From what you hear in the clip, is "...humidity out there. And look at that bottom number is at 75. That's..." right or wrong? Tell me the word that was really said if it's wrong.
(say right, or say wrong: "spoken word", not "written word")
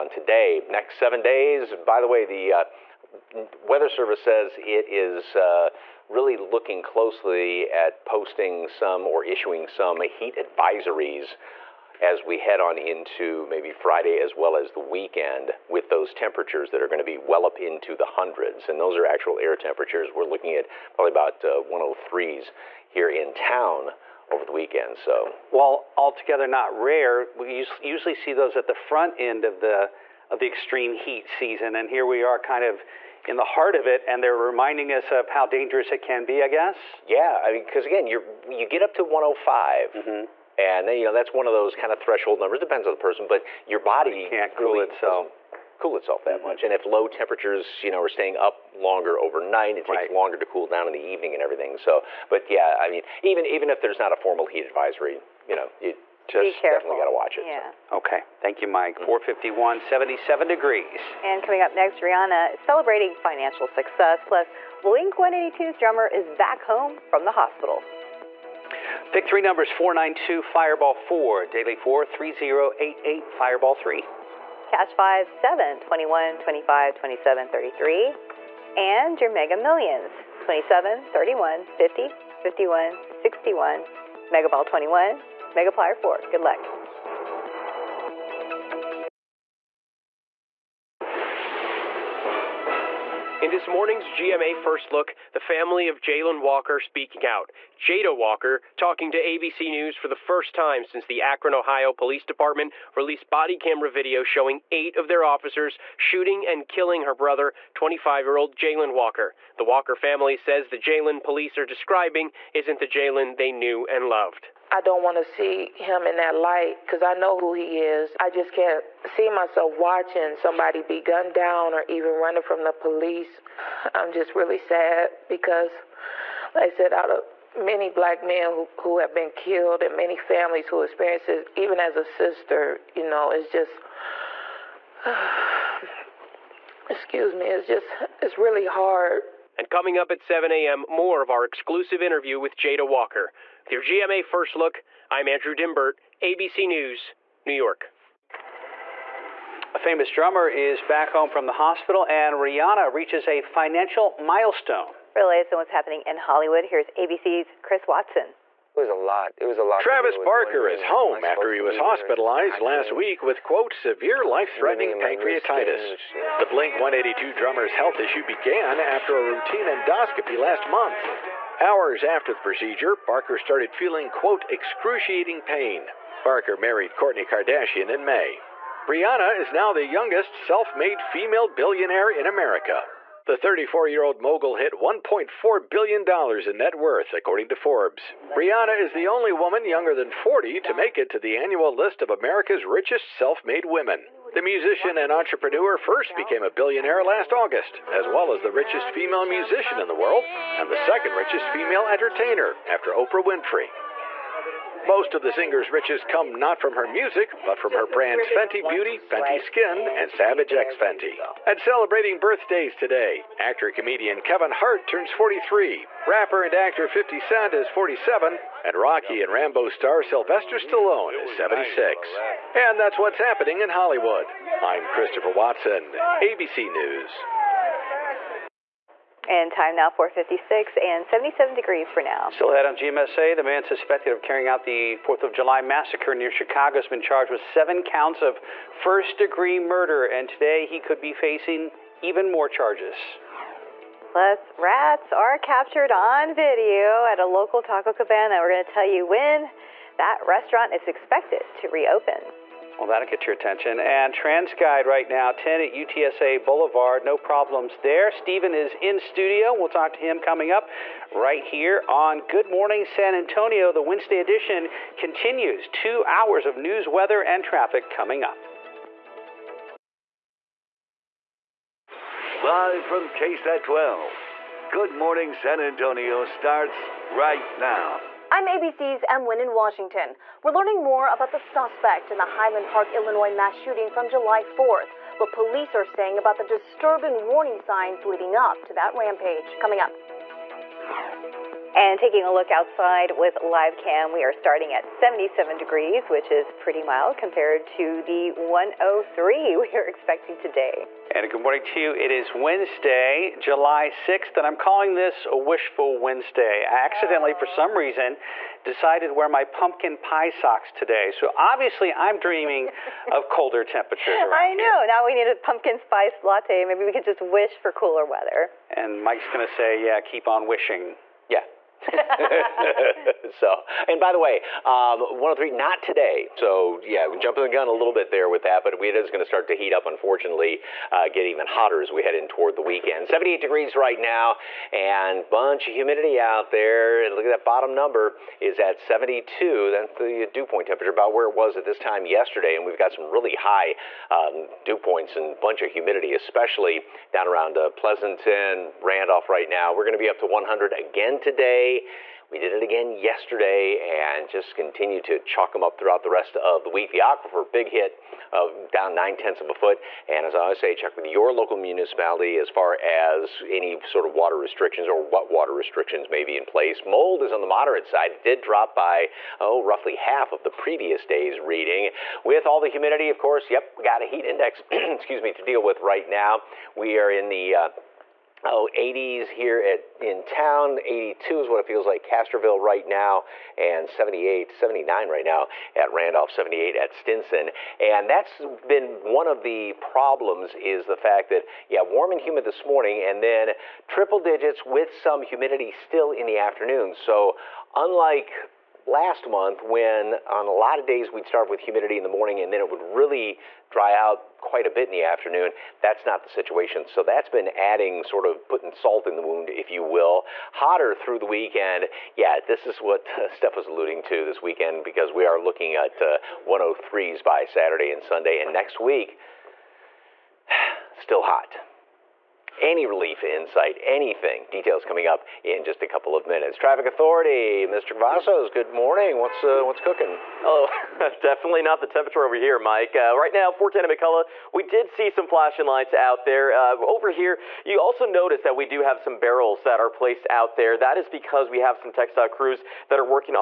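wrong: "72", not "75".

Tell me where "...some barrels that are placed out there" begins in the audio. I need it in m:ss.
7:18.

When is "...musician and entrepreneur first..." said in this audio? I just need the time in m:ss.
3:14.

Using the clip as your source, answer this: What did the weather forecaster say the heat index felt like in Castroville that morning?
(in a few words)
82.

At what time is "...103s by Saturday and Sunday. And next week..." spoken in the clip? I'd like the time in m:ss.
6:56.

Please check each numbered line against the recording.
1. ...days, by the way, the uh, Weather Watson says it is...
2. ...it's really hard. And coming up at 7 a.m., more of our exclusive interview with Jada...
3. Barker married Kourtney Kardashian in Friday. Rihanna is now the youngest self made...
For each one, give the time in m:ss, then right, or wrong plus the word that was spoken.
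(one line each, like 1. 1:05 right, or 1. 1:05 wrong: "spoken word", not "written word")
1. 0:01 wrong: "Service", not "Watson"
2. 2:18 right
3. 2:56 wrong: "May", not "Friday".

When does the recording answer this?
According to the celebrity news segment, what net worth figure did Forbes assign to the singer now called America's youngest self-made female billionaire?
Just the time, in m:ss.
3:04.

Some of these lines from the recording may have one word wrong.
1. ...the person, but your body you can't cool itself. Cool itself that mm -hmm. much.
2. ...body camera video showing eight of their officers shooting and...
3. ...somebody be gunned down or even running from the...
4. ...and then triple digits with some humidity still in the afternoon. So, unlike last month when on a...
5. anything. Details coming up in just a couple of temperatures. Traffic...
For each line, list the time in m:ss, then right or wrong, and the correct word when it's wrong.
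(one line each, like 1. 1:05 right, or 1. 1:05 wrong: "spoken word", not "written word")
1. 0:42 right
2. 1:43 right
3. 2:00 right
4. 6:33 right
5. 7:03 wrong: "minutes", not "temperatures".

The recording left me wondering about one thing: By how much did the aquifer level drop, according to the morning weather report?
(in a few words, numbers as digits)
0.9 feet.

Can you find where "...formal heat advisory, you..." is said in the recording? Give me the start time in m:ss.
0:54.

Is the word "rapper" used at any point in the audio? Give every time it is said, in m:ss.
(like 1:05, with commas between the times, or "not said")
3:36.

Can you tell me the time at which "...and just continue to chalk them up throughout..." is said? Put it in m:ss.
5:53.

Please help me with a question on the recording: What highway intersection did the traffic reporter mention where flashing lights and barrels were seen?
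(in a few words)
410 and McCullough.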